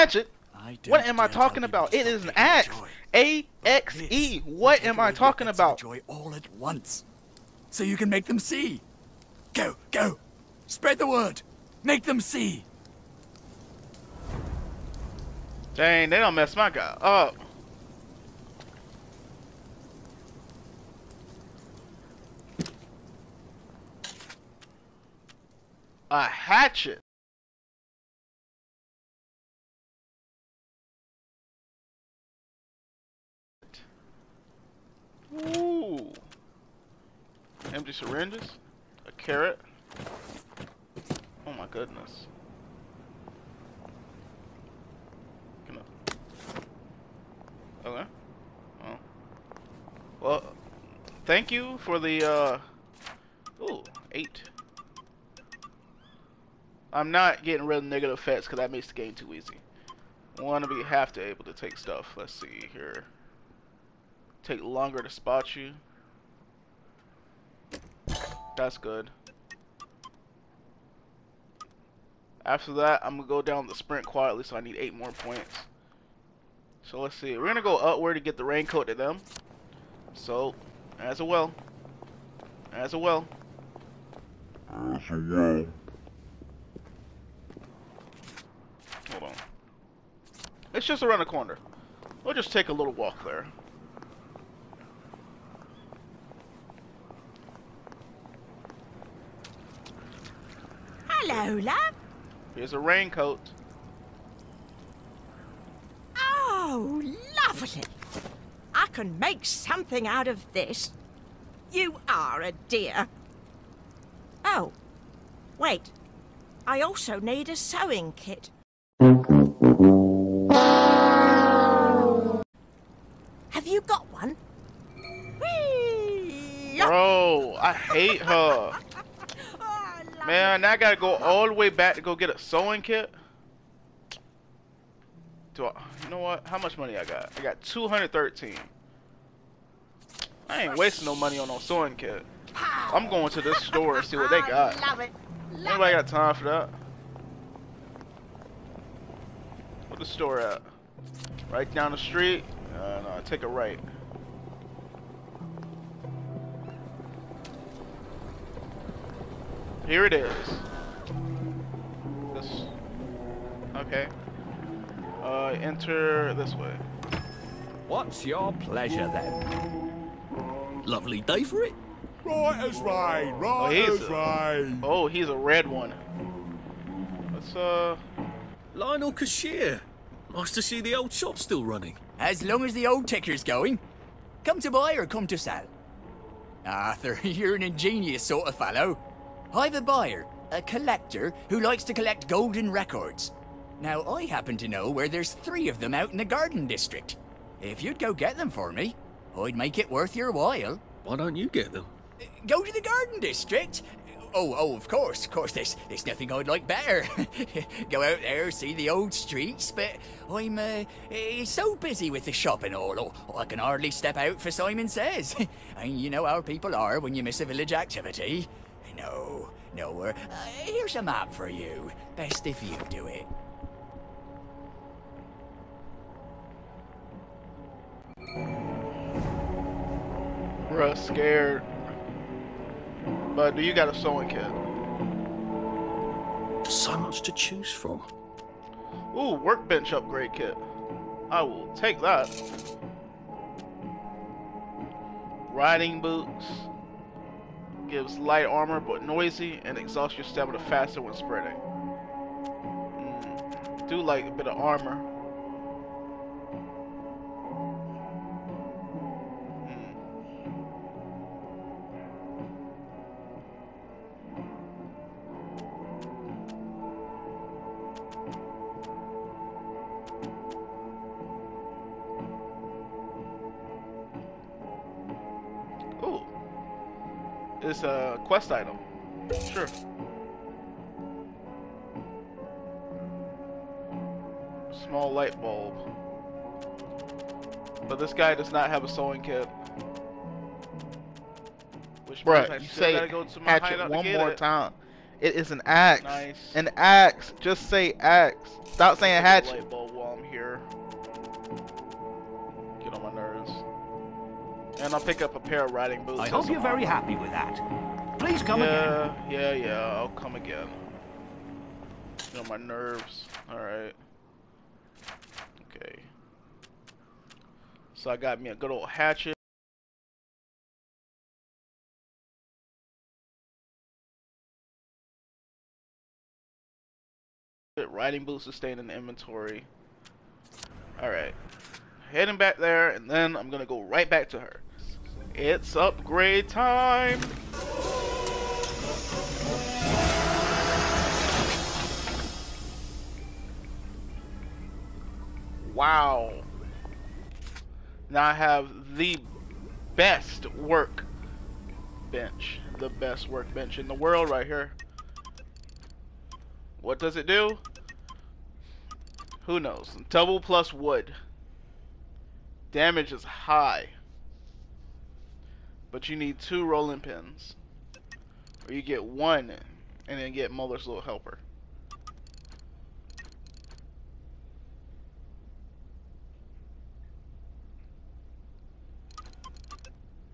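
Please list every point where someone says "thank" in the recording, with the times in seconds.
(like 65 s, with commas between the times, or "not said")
51 s.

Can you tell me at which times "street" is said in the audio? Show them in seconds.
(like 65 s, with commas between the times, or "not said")
151 s, 209 s.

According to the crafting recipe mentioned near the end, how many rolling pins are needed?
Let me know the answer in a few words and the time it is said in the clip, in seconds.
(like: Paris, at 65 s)
2, at 366 s.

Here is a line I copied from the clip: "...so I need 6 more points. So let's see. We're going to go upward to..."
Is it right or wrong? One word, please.
wrong.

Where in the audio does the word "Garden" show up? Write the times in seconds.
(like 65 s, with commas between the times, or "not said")
196 s, 202 s.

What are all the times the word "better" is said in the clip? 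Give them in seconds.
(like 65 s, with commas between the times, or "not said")
206 s.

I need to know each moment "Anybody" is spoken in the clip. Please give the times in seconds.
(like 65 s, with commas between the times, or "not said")
145 s.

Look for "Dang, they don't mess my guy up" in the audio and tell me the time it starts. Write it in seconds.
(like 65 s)
15 s.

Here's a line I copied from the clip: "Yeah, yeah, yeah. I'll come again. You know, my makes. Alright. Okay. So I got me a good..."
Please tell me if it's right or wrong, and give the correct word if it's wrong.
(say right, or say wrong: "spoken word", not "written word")
wrong: "nerves", not "makes".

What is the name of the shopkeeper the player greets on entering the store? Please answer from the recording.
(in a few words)
Lionel.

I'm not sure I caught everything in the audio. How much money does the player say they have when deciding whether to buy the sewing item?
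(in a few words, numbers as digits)
213.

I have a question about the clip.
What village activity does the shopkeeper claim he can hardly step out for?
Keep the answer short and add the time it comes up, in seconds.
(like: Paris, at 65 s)
Simon Says, at 214 s.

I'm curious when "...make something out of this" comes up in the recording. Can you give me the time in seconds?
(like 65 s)
109 s.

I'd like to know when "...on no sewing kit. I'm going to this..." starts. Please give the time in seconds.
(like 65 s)
141 s.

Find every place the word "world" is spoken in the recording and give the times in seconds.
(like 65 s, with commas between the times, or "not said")
353 s.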